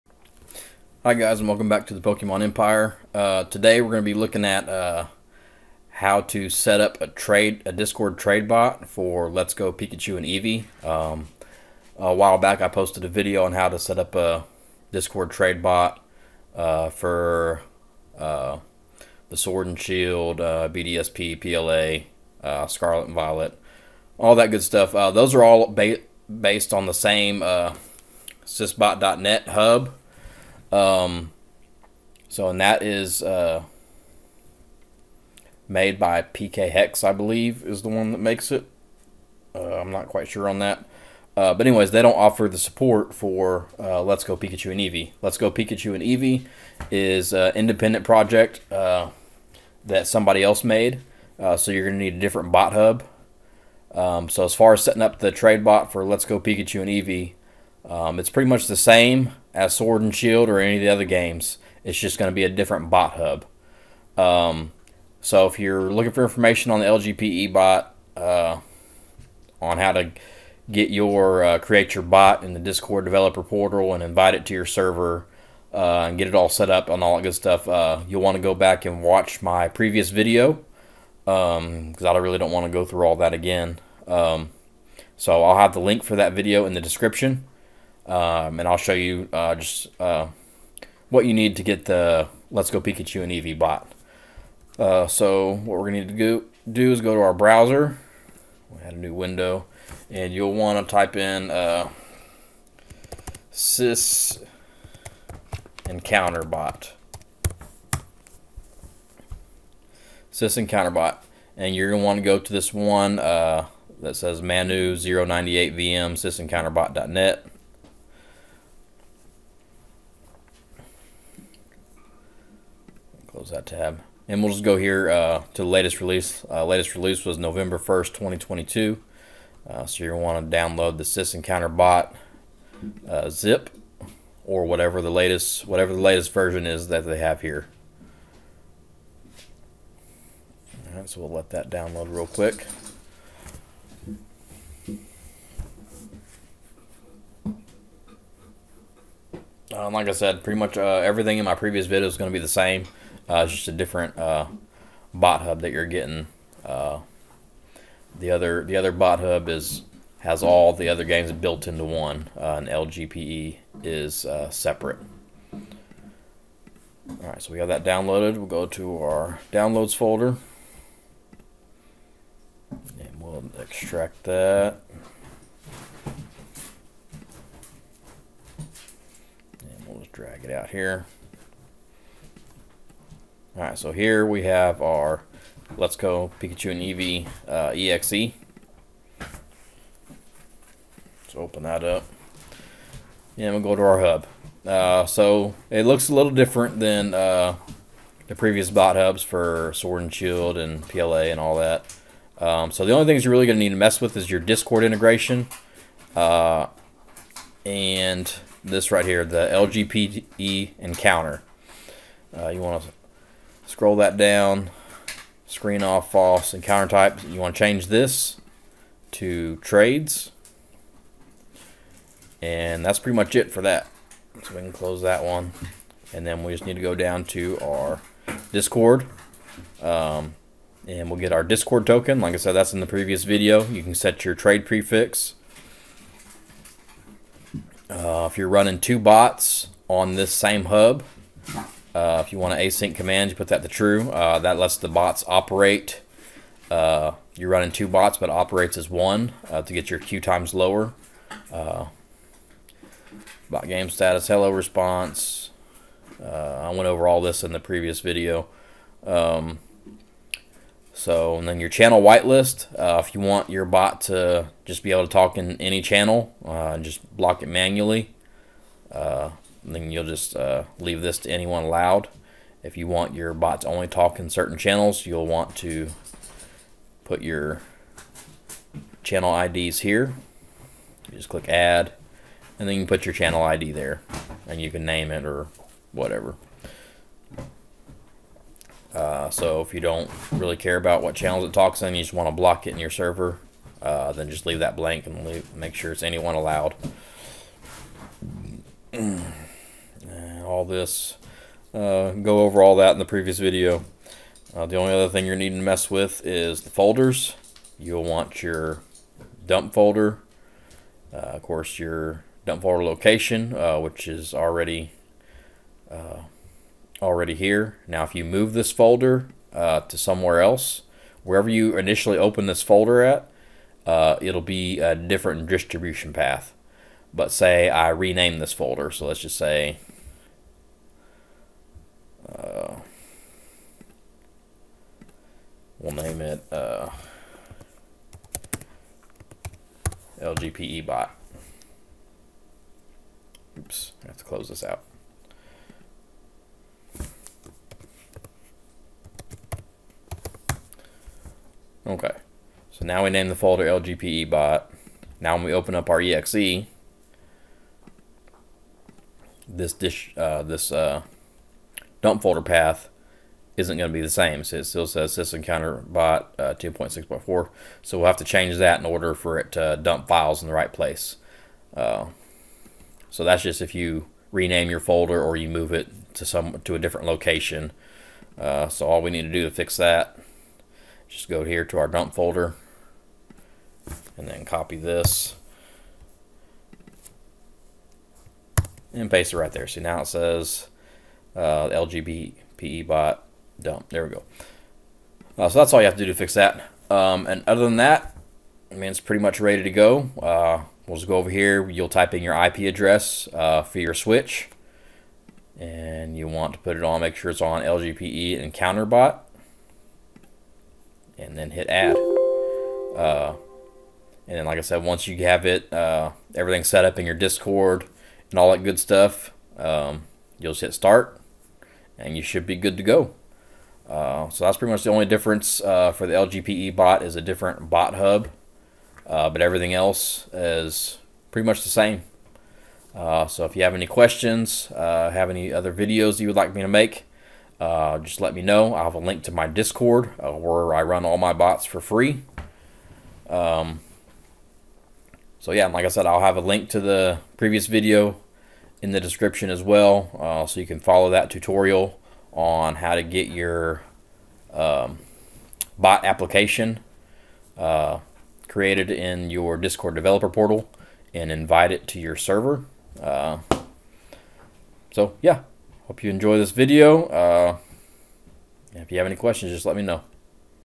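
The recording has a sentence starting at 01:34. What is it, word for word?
Uh, so what we're going to need to do, is go to our browser.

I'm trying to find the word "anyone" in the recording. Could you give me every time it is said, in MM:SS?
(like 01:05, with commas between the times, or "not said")
04:31, 04:56.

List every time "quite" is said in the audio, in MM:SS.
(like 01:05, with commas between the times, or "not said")
00:40.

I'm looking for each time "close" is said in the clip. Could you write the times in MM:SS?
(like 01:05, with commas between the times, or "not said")
02:03, 03:44, 05:44.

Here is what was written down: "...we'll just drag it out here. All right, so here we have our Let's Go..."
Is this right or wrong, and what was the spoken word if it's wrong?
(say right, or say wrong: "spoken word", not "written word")
right.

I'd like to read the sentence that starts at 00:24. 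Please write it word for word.
those are all ba based on the same sysbot.net hub.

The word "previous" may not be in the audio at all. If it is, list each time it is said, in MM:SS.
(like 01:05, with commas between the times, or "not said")
01:19, 02:31, 03:18, 03:52, 04:17, 05:03, 07:27.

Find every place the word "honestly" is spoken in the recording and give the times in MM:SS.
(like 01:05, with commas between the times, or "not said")
not said.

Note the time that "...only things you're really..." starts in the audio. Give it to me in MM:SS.
03:22.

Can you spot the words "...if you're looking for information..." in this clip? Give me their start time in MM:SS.
01:05.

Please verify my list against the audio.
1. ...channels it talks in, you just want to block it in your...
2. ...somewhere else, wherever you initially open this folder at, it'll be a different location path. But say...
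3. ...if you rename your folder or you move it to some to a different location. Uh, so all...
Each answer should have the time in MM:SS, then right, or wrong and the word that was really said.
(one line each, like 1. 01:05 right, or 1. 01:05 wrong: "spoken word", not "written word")
1. 04:51 right
2. 05:19 wrong: "distribution", not "location"
3. 06:13 right.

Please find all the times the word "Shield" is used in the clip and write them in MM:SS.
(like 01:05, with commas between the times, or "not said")
00:19, 01:00, 03:20.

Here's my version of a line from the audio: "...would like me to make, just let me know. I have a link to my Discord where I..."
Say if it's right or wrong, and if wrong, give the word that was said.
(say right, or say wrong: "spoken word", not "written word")
right.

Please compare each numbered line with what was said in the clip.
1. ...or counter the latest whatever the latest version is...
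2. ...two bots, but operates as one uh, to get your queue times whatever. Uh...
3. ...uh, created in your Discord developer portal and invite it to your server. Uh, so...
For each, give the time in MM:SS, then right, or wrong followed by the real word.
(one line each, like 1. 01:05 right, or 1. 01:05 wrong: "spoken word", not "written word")
1. 02:14 wrong: "whatever", not "counter"
2. 04:07 wrong: "lower", not "whatever"
3. 07:37 right.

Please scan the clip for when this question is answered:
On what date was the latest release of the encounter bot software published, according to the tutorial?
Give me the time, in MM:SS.
02:07.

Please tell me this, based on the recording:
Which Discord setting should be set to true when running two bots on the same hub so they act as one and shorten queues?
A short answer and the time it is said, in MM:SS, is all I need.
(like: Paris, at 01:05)
Async command, at 04:02.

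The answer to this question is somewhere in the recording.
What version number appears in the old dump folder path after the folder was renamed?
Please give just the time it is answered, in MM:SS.
06:06.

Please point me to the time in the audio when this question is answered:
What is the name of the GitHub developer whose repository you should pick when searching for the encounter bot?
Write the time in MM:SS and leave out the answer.
01:54.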